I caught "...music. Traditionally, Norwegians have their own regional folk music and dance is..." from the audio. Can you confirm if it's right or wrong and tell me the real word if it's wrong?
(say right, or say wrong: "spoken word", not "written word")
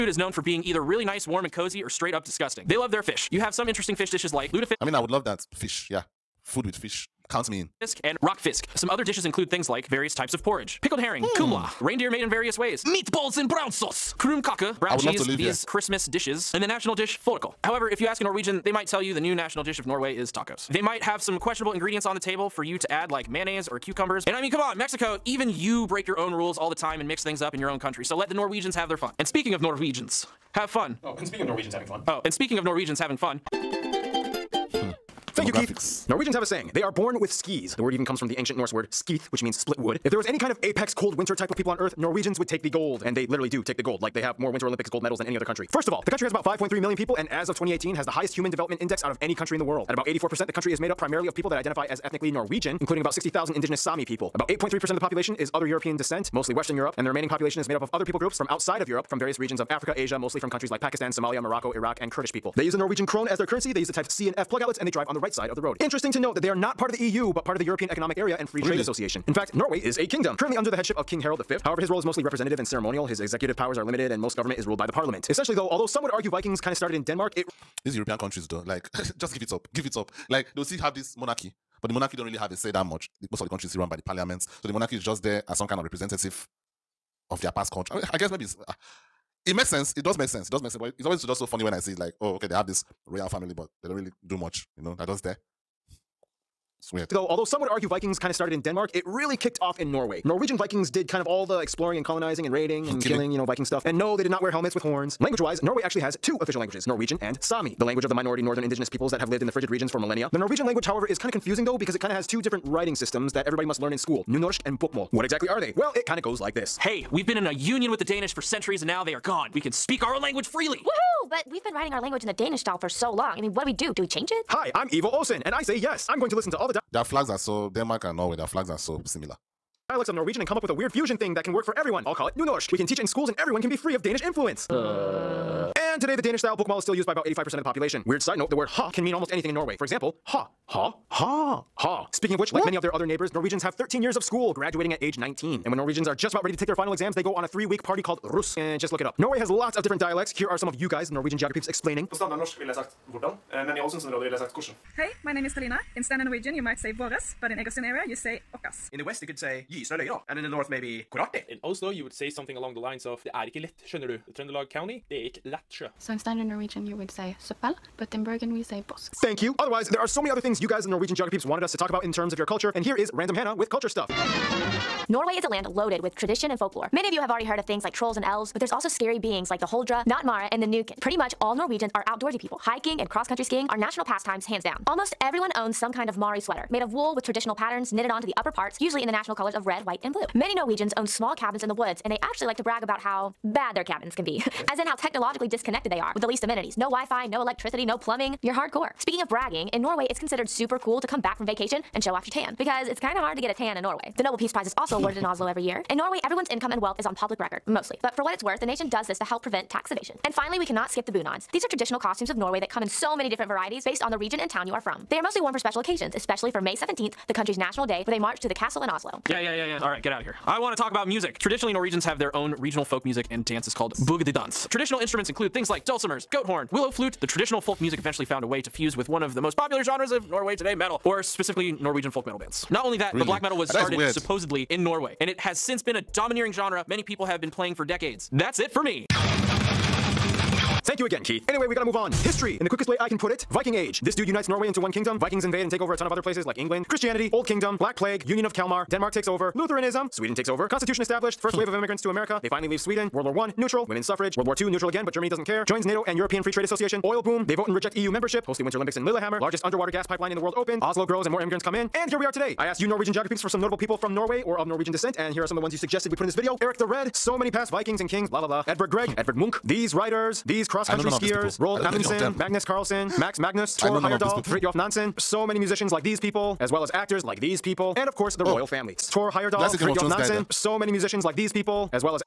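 right.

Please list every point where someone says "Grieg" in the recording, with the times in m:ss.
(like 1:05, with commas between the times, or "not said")
4:28.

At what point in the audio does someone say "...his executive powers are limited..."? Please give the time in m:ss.
1:13.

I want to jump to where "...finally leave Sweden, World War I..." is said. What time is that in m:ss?
4:12.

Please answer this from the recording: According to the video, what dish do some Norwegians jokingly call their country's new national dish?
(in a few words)
Tacos.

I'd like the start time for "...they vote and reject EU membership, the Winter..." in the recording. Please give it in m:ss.
4:17.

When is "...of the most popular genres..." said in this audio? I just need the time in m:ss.
3:49.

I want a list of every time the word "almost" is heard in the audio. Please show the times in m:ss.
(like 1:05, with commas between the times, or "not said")
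2:19, 3:04.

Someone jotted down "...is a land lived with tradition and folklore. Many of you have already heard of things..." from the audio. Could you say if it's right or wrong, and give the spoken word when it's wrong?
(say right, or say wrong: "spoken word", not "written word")
wrong: "loaded", not "lived".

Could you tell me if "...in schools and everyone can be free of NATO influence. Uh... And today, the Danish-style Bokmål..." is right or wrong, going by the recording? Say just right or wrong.
wrong.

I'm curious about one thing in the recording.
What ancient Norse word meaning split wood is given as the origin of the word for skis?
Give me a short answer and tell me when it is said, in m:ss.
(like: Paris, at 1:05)
skith, at 0:38.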